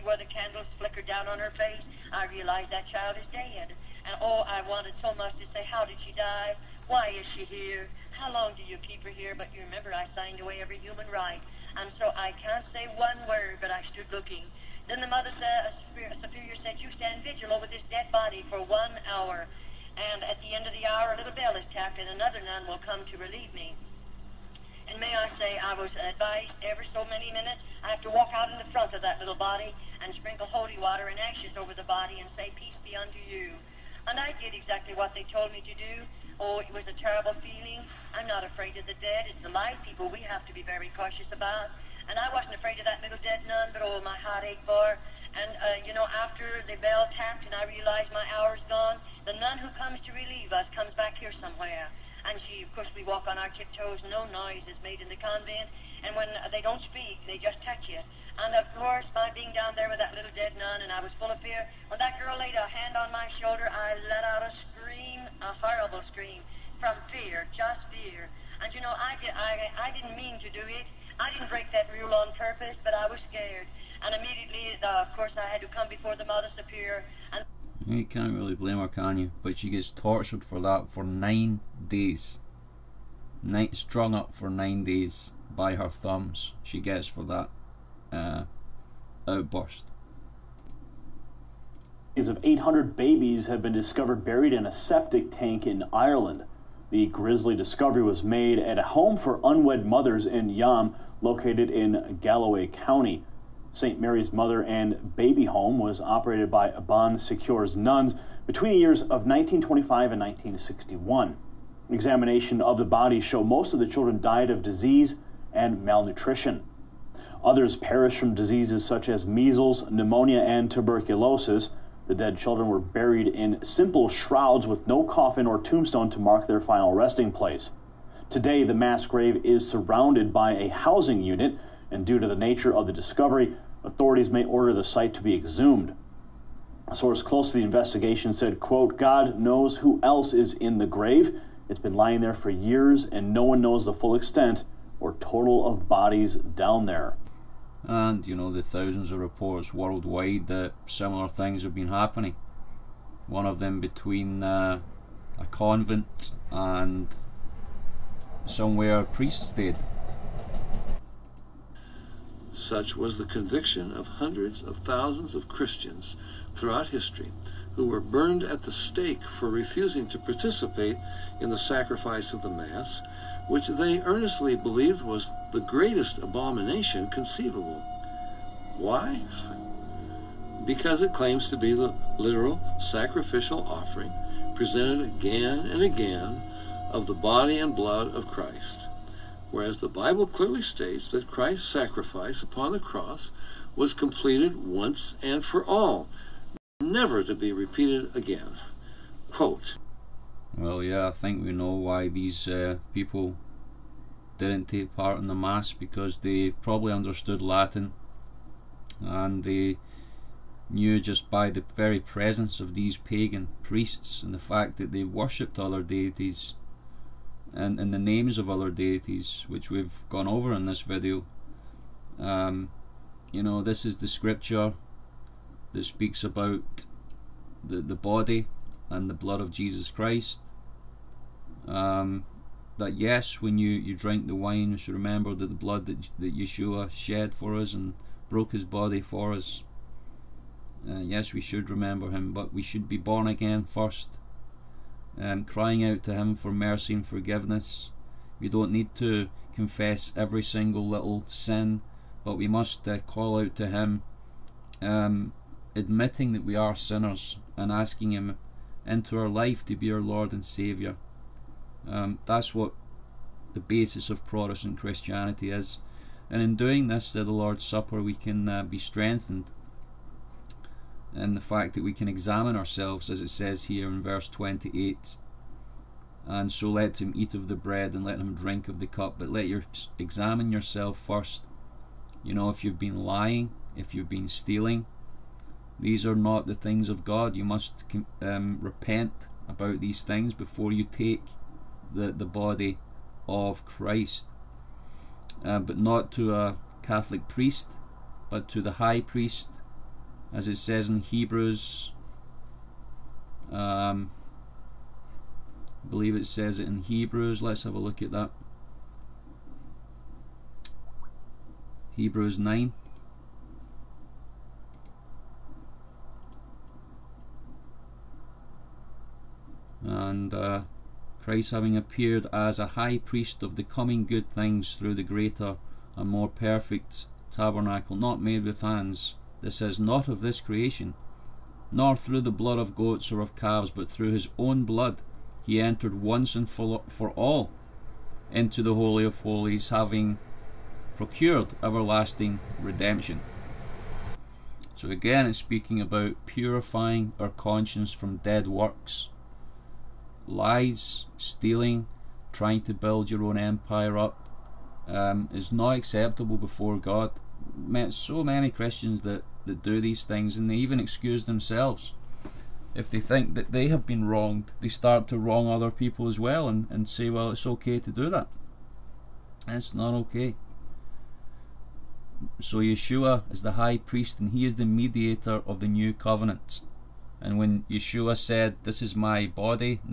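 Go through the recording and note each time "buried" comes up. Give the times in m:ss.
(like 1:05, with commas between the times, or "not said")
1:34, 2:02.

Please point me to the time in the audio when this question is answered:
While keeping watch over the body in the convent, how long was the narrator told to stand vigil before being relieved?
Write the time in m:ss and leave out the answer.
0:18.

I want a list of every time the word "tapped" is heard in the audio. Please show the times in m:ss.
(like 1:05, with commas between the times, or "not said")
0:21, 0:47.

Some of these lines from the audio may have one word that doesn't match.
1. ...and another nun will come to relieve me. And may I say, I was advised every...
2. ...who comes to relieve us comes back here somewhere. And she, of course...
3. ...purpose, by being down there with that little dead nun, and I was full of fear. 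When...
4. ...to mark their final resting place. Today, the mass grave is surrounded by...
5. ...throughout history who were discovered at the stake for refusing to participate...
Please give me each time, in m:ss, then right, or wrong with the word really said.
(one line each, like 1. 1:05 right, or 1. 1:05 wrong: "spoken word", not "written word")
1. 0:22 right
2. 0:49 right
3. 0:58 wrong: "course", not "purpose"
4. 2:06 right
5. 2:46 wrong: "burned", not "discovered".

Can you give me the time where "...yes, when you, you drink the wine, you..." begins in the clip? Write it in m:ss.
3:52.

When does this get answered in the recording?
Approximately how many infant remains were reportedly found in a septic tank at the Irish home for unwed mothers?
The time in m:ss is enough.
1:32.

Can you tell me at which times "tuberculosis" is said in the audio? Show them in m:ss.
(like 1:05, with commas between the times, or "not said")
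2:00.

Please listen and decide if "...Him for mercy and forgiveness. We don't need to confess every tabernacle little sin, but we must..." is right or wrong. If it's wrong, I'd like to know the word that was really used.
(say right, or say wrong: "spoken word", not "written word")
wrong: "single", not "tabernacle".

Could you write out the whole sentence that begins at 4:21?
Um, that's what the basis of Protestant Christianity is.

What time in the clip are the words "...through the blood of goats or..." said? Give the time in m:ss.
5:31.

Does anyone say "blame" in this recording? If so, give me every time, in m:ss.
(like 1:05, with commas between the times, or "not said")
1:18.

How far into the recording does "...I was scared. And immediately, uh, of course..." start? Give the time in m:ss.
1:12.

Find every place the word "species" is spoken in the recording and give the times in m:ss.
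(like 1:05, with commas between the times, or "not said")
not said.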